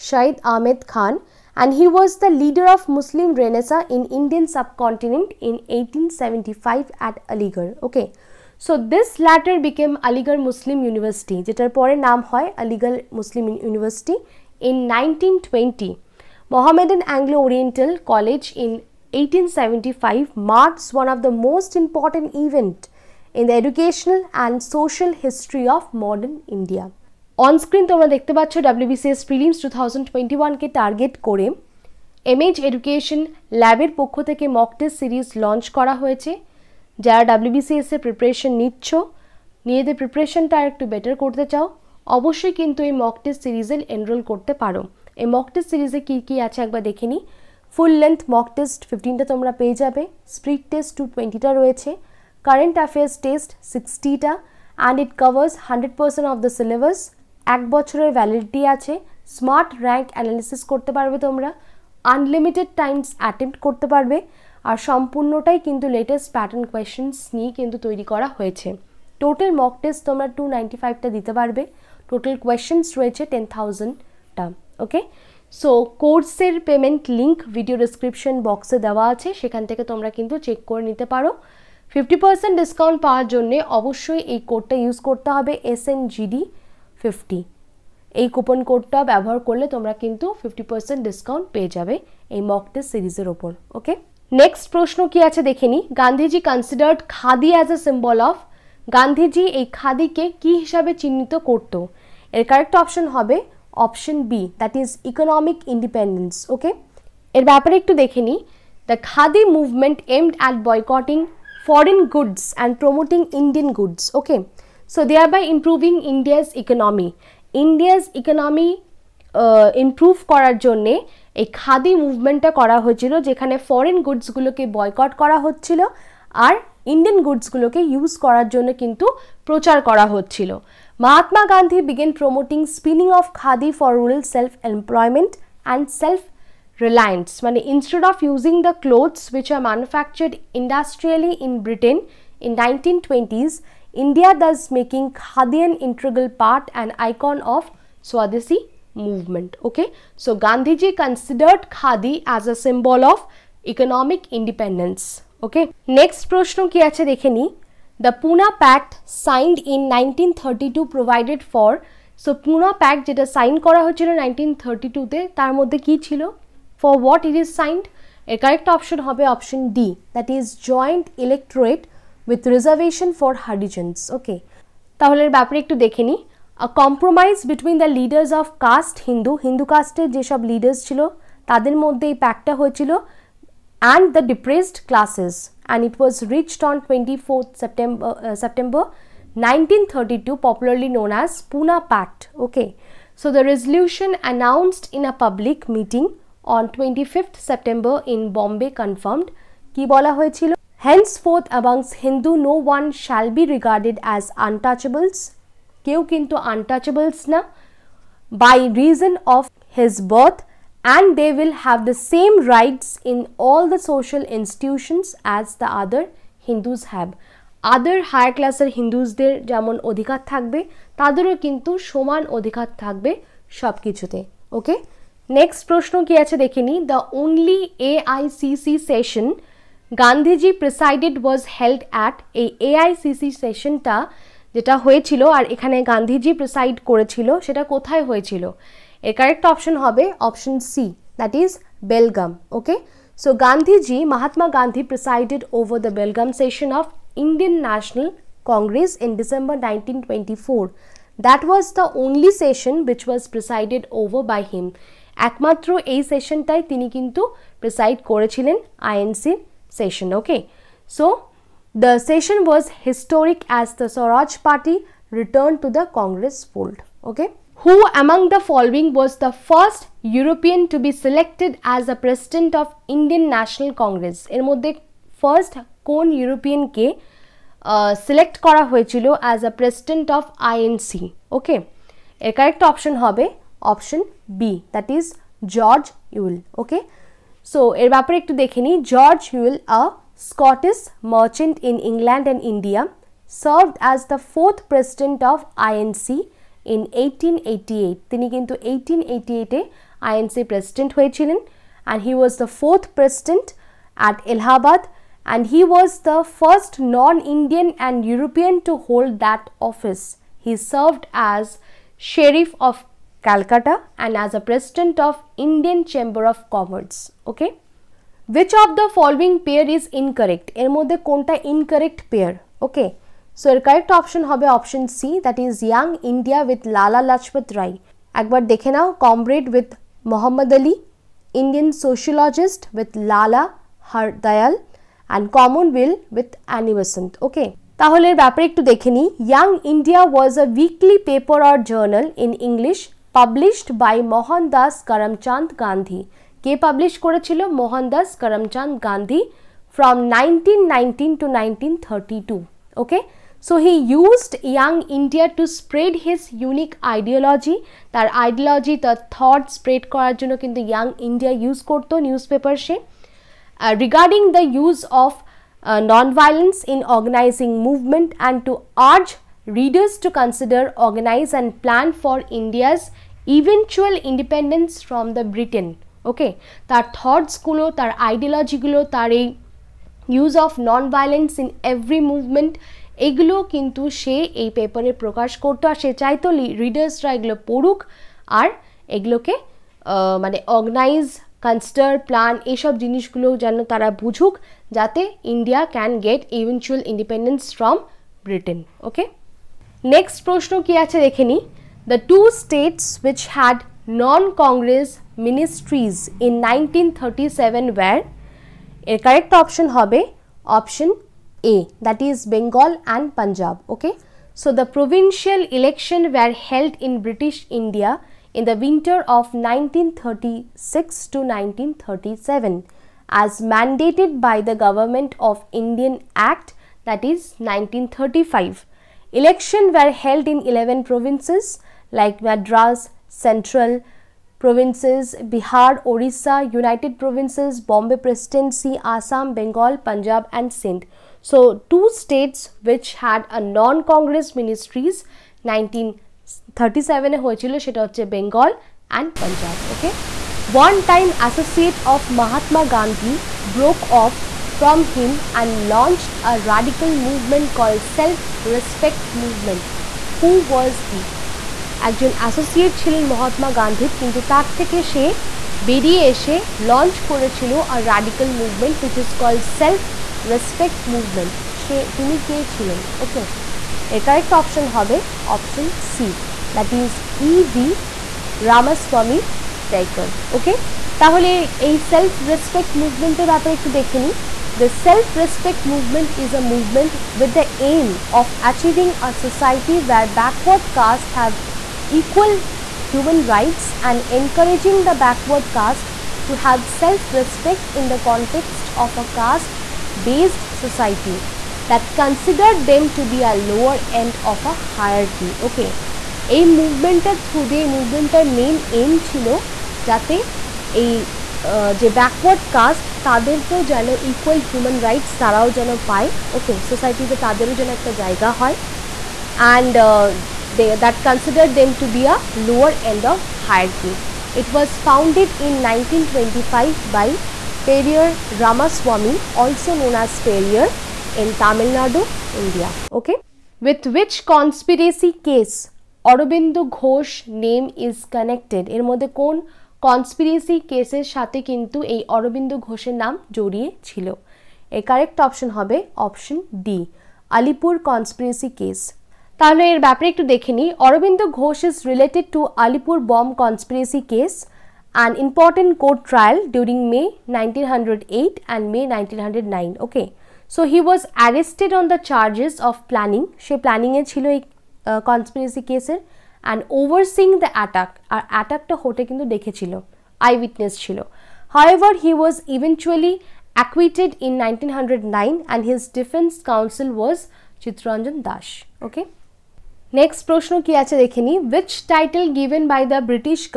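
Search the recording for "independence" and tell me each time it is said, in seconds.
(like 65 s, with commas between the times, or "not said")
154 s, 374 s.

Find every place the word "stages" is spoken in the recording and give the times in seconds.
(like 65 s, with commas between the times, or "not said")
not said.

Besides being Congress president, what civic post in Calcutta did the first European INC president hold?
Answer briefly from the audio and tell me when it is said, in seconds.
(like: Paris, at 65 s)
Sheriff, at 312 s.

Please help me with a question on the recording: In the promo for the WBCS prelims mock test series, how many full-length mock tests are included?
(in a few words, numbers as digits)
15.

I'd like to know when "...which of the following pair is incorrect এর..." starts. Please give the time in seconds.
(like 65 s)
318 s.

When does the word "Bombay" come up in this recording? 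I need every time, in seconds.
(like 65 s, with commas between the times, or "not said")
198 s, 437 s.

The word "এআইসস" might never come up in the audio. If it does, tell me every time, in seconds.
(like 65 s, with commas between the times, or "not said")
227 s, 232 s.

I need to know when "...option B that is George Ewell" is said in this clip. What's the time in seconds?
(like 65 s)
284 s.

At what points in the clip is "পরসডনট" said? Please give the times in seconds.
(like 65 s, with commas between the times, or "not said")
279 s, 300 s.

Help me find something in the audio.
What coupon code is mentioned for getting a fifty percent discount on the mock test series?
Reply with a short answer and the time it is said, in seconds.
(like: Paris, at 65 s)
SNGD50, at 85 s.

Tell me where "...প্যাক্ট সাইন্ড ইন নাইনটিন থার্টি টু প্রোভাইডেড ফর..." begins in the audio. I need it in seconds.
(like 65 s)
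158 s.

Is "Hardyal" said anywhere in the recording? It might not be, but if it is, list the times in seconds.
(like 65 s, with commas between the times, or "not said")
333 s.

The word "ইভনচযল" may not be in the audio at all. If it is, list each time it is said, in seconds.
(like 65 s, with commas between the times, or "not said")
396 s, 572 s.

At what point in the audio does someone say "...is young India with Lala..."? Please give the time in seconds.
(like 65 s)
325 s.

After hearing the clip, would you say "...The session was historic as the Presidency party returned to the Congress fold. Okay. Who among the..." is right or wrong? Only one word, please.
wrong.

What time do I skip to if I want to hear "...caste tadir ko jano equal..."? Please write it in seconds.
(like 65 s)
512 s.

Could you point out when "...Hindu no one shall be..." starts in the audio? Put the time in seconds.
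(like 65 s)
202 s.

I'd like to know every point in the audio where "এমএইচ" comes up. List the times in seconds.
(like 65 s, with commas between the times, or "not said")
32 s.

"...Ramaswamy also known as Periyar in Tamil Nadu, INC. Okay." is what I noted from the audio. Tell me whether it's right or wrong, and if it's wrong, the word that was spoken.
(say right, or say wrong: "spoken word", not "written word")
wrong: "India", not "INC".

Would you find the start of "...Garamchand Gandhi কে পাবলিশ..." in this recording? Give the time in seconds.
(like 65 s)
344 s.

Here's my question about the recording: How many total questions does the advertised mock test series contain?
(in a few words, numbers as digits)
10,000.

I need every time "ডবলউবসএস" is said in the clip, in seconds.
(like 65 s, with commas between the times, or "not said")
28 s, 37 s.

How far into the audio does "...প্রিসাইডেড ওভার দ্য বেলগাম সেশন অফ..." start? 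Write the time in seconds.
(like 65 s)
244 s.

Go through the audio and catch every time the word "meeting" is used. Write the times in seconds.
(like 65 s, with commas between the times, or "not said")
195 s.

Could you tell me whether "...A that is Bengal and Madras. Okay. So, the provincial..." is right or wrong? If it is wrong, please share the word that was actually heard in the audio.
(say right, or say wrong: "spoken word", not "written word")
wrong: "Punjab", not "Madras".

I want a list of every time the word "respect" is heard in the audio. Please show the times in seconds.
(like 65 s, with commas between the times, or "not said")
458 s, 496 s.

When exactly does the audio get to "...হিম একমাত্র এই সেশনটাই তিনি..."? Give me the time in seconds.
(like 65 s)
254 s.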